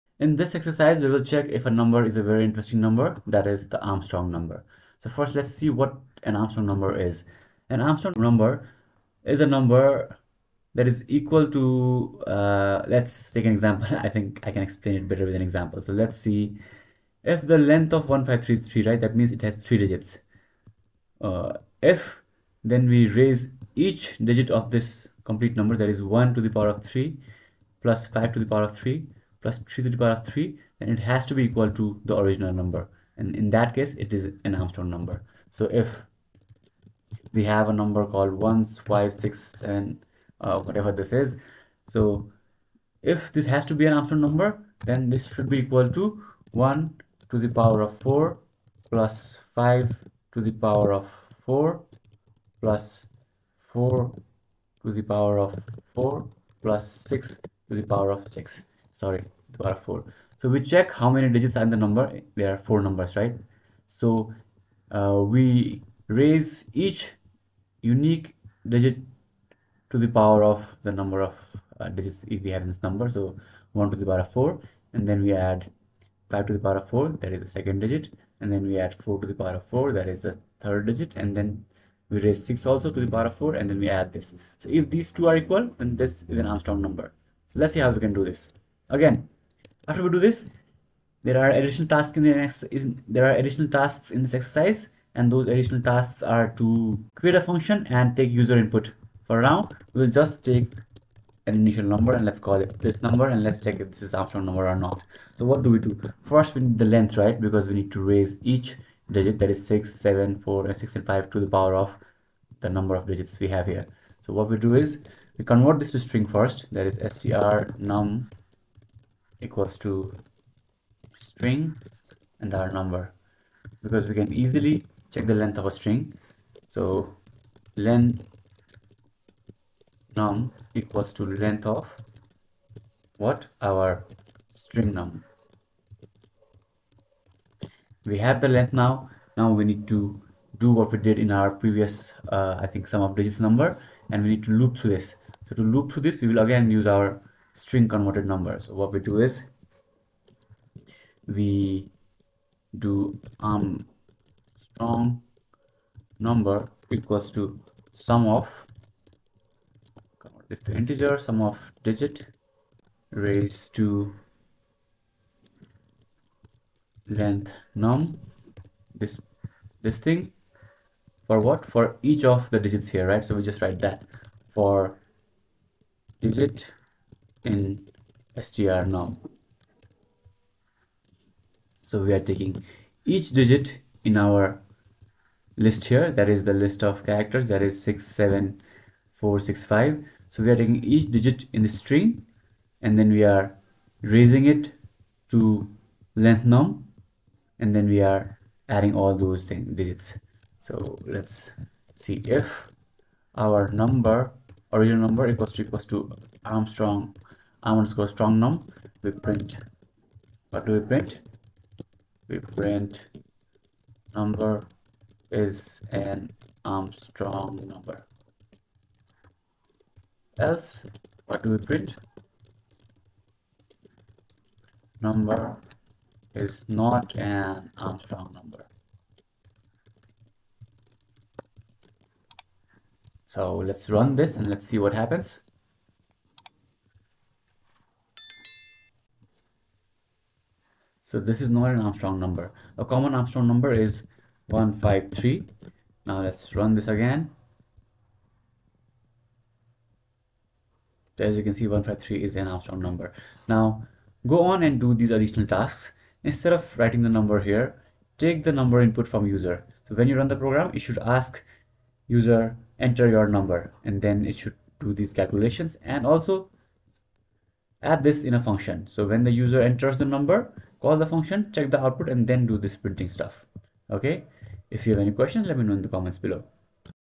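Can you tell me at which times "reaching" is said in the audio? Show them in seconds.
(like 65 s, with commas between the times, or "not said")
not said.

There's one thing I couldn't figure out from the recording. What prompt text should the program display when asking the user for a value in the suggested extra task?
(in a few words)
enter your number.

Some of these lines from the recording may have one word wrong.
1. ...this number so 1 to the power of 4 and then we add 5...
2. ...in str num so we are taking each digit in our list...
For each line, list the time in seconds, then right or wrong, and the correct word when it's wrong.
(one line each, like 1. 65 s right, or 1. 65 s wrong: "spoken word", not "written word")
1. 72 s right
2. 177 s right.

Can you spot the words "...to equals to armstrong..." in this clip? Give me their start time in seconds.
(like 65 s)
205 s.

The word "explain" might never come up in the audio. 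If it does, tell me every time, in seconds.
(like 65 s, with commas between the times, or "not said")
14 s.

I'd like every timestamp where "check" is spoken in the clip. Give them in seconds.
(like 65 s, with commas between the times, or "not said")
1 s, 60 s, 103 s, 125 s, 271 s.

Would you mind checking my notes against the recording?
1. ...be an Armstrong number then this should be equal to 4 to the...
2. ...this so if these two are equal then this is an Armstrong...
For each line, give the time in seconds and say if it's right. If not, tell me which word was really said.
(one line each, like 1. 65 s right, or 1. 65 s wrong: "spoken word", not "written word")
1. 43 s wrong: "1", not "4"
2. 84 s right.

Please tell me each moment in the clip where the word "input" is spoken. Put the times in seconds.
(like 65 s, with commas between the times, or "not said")
98 s, 258 s.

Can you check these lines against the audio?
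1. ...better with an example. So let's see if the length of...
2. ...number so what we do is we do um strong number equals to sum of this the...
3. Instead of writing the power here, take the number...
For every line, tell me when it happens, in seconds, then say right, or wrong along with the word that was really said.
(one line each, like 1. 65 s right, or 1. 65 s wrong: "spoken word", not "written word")
1. 15 s right
2. 148 s right
3. 256 s wrong: "number", not "power".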